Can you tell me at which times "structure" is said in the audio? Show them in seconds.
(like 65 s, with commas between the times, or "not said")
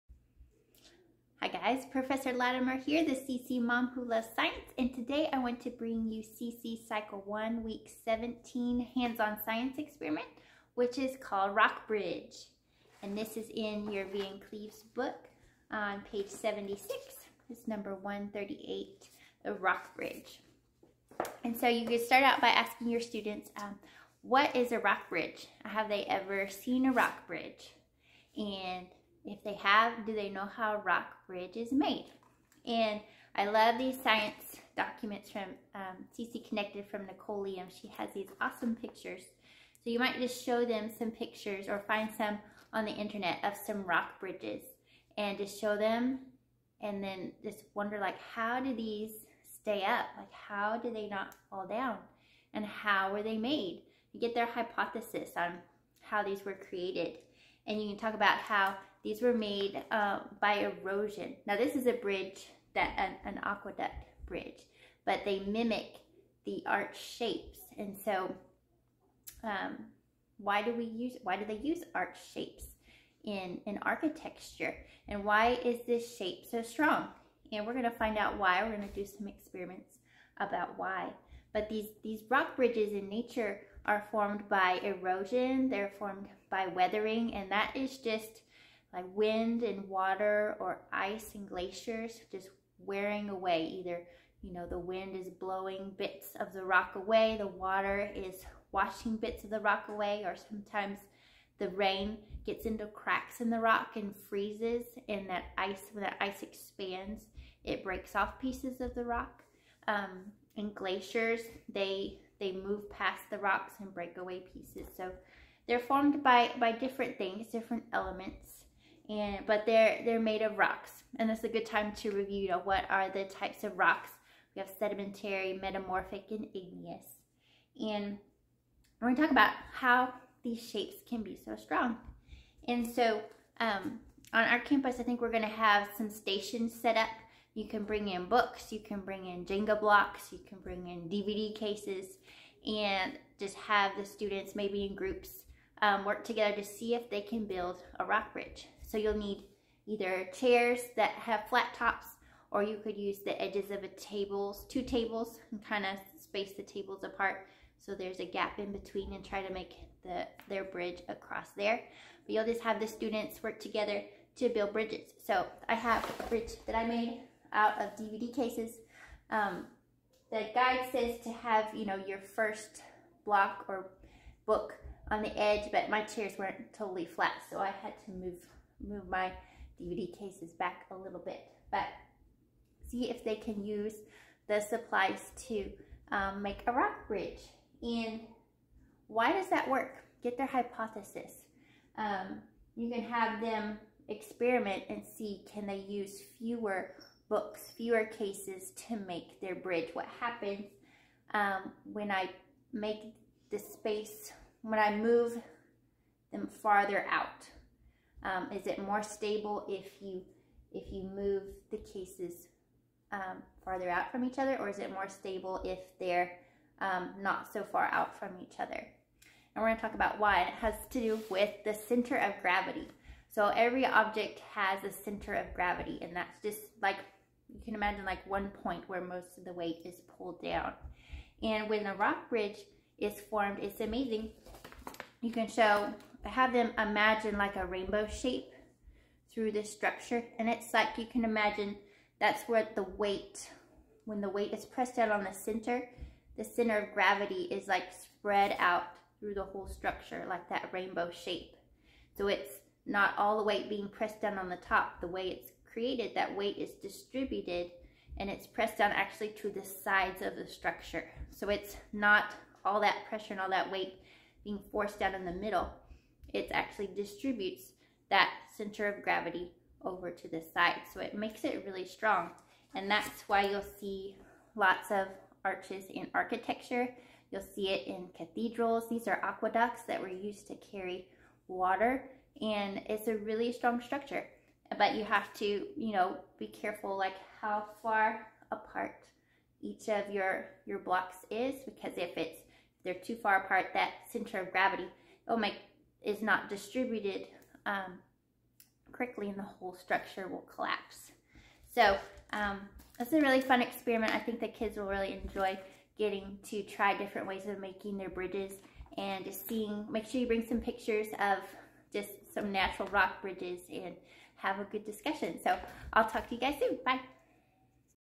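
239 s, 249 s, 260 s, 283 s, 299 s.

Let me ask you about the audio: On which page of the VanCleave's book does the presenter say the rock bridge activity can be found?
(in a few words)
76.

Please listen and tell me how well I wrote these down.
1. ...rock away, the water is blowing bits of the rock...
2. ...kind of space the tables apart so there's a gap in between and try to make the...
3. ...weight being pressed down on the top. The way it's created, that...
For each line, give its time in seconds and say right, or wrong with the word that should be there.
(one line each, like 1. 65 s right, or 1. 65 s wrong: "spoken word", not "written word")
1. 96 s wrong: "washing", not "blowing"
2. 155 s right
3. 253 s right.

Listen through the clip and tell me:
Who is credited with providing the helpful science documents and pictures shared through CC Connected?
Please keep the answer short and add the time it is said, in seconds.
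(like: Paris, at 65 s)
Nicoleum, at 37 s.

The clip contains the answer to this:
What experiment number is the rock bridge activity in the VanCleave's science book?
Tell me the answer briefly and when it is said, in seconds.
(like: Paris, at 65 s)
138, at 17 s.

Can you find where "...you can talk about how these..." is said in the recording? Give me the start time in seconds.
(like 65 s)
57 s.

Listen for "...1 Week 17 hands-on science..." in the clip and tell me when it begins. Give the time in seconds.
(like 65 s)
7 s.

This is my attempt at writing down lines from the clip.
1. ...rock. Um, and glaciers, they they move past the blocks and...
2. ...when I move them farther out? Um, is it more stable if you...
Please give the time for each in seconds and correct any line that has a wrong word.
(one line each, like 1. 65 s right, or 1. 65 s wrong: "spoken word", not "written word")
1. 109 s wrong: "rocks", not "blocks"
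2. 204 s right.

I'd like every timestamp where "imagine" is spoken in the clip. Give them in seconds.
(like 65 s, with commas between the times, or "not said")
227 s, 236 s, 241 s.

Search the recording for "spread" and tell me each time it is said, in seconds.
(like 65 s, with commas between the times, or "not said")
247 s.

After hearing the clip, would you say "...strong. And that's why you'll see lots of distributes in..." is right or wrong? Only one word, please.
wrong.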